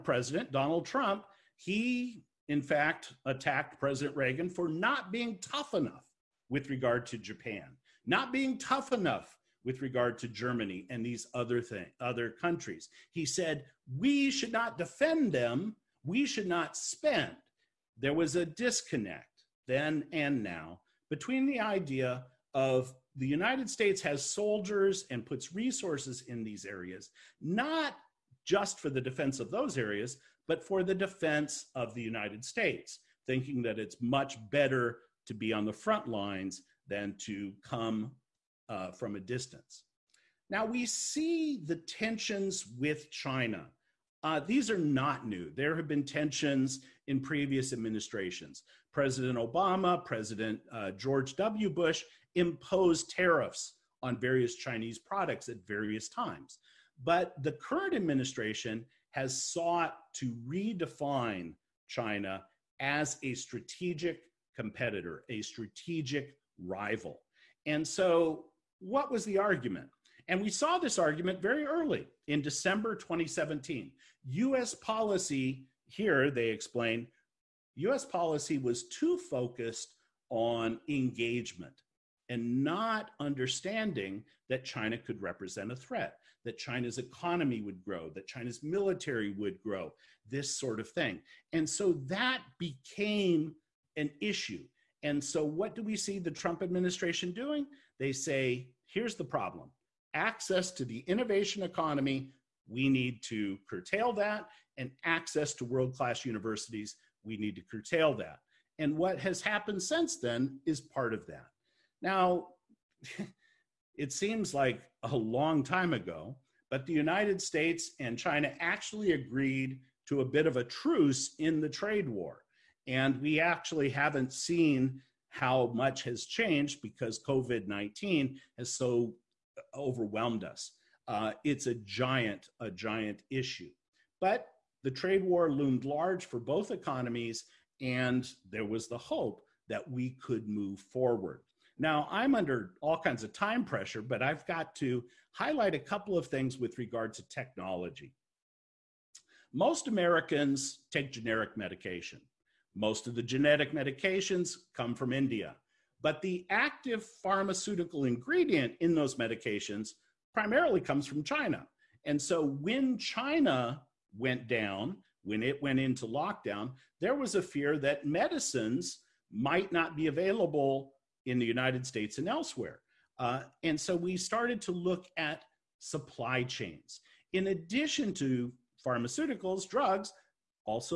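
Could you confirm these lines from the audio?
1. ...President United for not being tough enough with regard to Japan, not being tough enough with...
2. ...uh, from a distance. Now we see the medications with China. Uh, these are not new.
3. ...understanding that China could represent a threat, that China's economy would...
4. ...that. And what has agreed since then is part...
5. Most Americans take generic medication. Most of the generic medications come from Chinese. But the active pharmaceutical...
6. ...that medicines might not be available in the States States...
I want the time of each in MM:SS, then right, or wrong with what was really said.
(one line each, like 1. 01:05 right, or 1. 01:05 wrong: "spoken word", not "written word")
1. 00:03 wrong: "Reagan", not "United"
2. 00:38 wrong: "tensions", not "medications"
3. 01:23 right
4. 01:48 wrong: "happened", not "agreed"
5. 02:29 wrong: "India", not "Chinese"
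6. 02:47 wrong: "United", not "States".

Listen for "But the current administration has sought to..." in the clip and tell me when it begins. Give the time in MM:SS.
00:57.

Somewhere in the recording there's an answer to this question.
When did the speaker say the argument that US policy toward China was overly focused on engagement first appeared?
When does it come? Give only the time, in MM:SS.
01:12.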